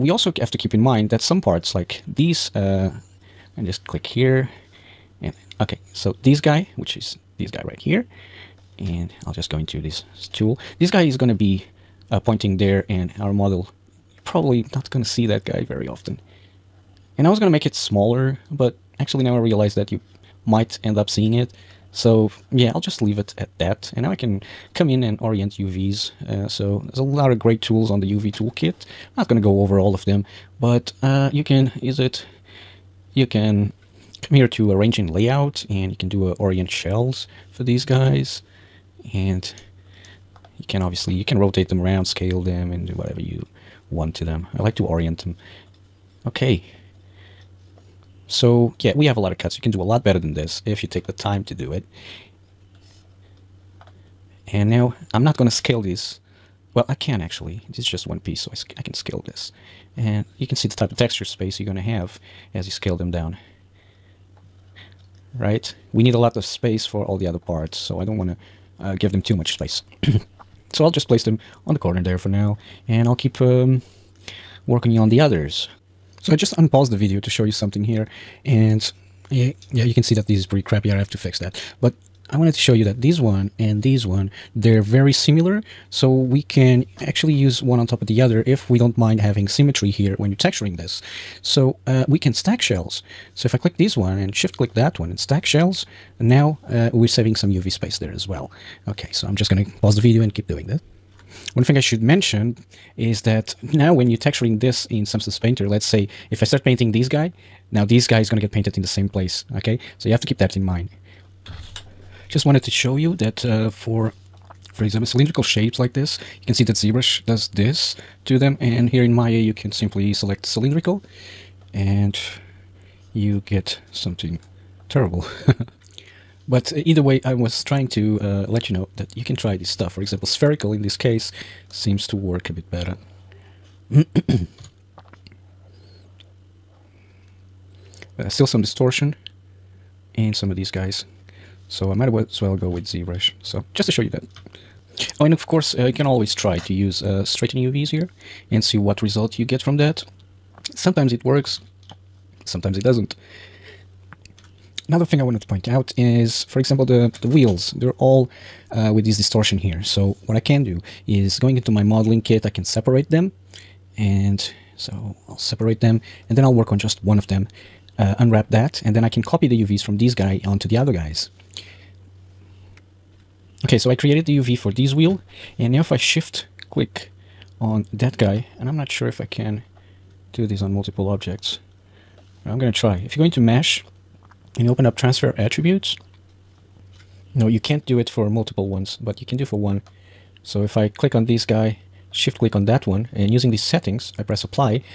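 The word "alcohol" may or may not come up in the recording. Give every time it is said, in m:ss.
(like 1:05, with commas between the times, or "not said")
not said.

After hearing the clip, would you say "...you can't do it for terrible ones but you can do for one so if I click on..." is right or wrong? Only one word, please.
wrong.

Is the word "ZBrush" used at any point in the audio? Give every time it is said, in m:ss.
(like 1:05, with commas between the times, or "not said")
1:56, 2:22.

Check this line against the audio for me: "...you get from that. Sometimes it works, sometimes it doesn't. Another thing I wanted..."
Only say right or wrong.
right.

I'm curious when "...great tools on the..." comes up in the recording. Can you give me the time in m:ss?
0:27.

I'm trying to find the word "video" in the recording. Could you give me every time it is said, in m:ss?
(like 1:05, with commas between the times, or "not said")
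1:16, 1:39.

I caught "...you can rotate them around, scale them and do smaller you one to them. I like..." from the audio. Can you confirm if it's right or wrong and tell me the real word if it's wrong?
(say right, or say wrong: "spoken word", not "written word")
wrong: "whatever", not "smaller".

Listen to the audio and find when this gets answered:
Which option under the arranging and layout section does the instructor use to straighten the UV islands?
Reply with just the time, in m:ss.
0:36.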